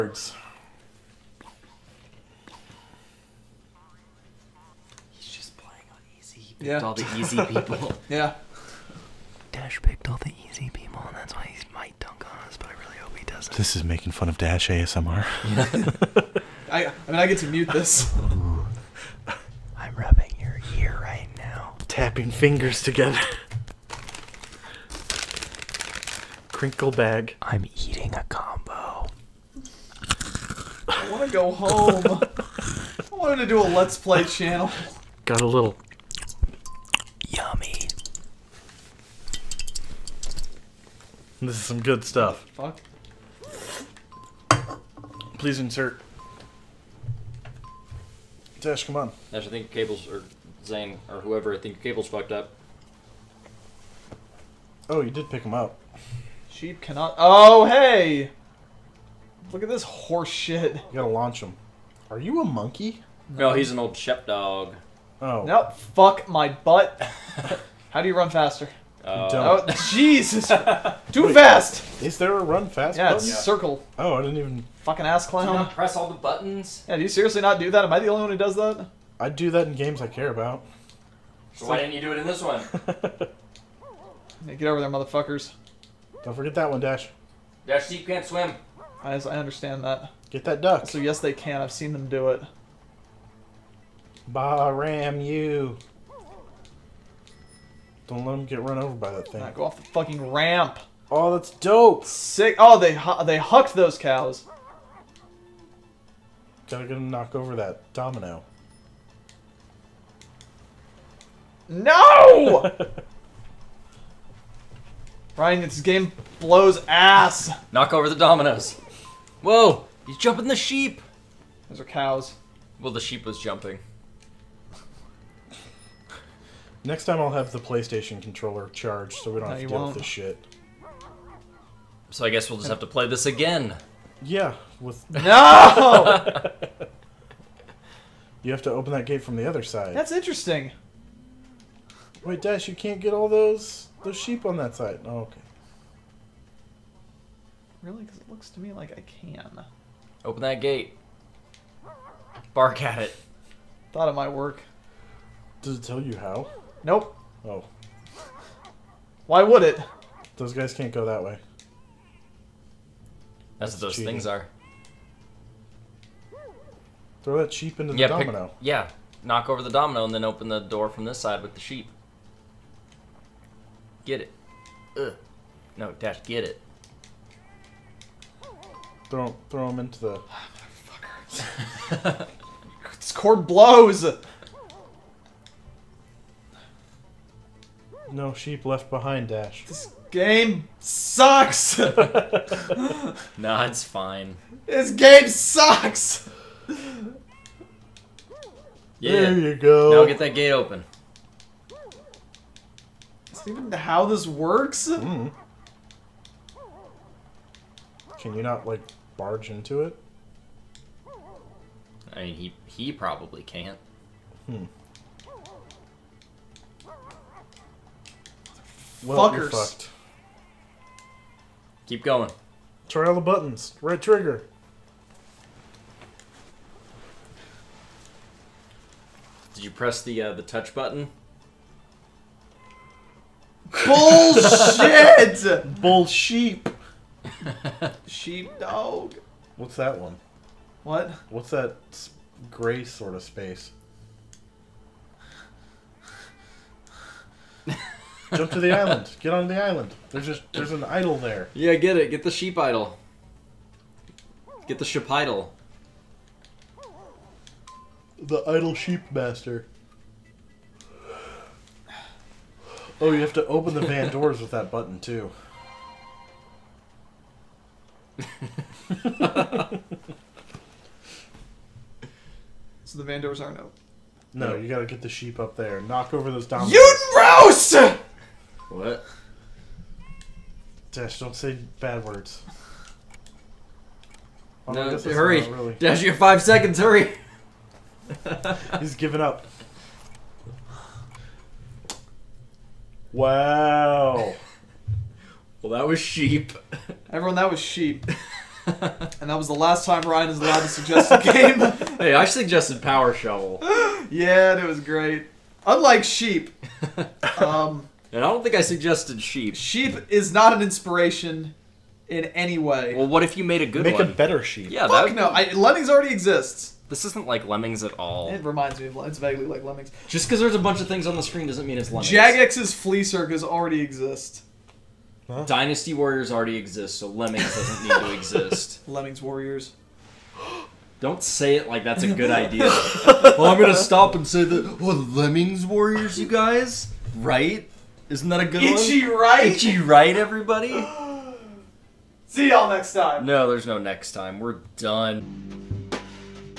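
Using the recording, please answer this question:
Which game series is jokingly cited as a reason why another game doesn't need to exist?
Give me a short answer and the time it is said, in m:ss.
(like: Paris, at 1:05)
Dynasty Warriors, at 5:25.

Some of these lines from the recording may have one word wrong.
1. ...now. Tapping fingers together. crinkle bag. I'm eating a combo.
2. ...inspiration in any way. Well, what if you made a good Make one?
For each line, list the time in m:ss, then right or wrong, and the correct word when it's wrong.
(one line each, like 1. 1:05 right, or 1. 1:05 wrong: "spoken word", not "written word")
1. 0:21 right
2. 5:10 right.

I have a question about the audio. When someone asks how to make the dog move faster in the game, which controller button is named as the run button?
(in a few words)
Circle.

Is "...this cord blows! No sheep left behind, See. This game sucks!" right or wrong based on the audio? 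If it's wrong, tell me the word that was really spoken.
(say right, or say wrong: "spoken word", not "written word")
wrong: "Dash", not "See".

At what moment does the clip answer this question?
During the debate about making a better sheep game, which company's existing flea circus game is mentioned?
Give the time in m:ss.
5:22.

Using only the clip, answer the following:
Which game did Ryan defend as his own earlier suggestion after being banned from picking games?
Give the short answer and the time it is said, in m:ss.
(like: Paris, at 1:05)
Power Shovel, at 5:02.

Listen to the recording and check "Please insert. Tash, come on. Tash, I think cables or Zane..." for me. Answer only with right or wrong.
right.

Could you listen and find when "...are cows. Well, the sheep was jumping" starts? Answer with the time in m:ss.
2:01.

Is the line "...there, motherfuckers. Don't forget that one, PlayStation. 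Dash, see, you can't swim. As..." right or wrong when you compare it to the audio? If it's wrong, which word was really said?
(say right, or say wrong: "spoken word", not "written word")
wrong: "Dash", not "PlayStation".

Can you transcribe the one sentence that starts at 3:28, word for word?
Can you not, like, barge into it?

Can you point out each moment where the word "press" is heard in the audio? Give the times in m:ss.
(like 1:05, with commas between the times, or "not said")
1:15, 3:49.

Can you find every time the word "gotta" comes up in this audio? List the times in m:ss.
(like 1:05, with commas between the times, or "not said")
1:00, 1:46, 4:34.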